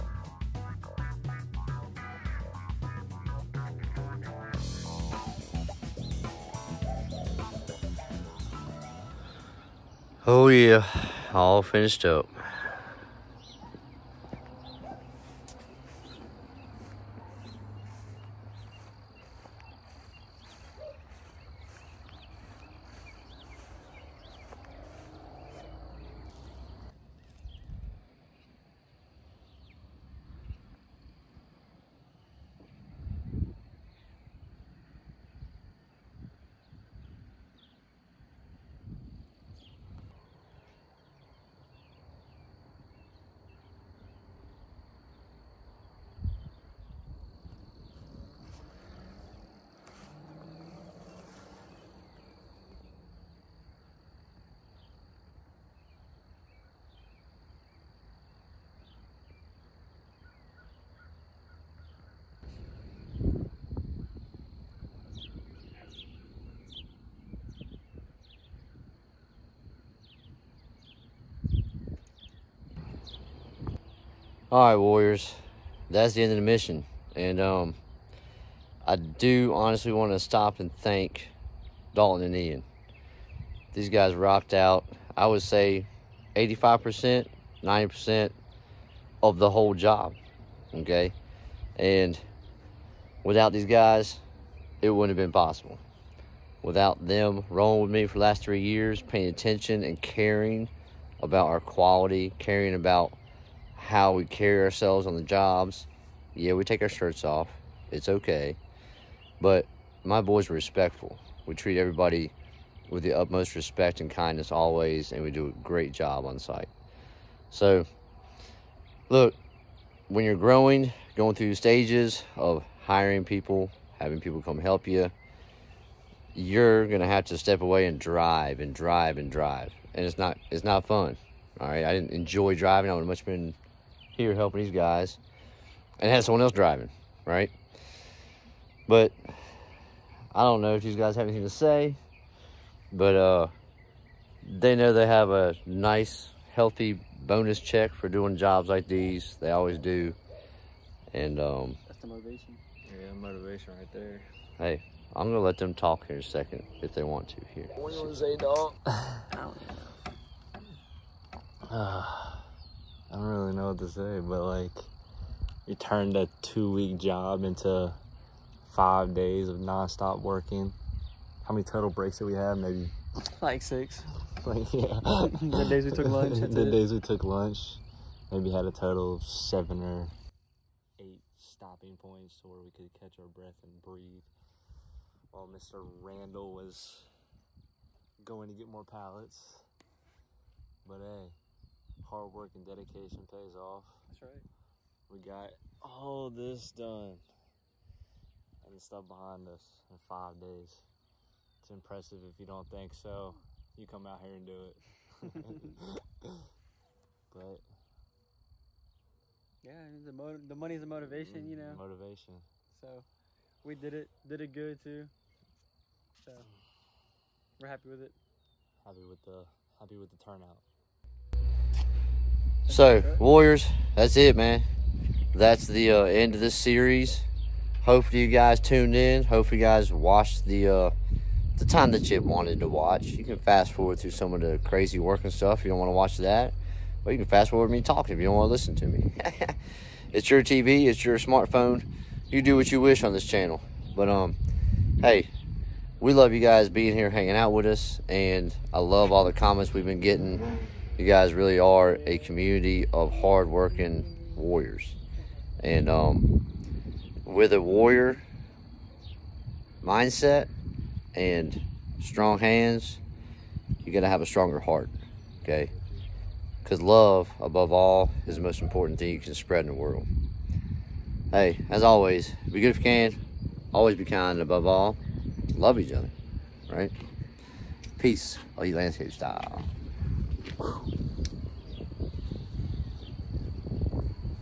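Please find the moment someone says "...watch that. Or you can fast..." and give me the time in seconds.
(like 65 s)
235 s.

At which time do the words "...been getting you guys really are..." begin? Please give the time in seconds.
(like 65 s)
249 s.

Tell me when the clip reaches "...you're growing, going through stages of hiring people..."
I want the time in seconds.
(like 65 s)
120 s.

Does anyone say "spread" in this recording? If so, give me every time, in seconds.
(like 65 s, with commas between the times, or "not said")
269 s.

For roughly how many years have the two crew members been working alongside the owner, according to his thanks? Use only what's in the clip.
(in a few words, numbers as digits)
3 years.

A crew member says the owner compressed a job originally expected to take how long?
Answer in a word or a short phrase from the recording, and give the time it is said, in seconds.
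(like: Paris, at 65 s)
2 weeks, at 166 s.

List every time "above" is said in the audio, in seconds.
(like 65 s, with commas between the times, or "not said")
267 s, 274 s.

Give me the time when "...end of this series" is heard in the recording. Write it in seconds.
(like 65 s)
226 s.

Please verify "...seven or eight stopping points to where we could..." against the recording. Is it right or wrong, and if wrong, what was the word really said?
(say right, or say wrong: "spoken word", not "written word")
right.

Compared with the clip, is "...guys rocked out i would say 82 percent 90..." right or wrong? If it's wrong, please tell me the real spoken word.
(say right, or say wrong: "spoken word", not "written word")
wrong: "85", not "82".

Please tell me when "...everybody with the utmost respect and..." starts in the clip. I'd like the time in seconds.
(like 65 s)
111 s.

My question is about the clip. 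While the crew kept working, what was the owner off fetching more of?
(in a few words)
Pallets.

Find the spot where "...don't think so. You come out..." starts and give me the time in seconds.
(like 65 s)
202 s.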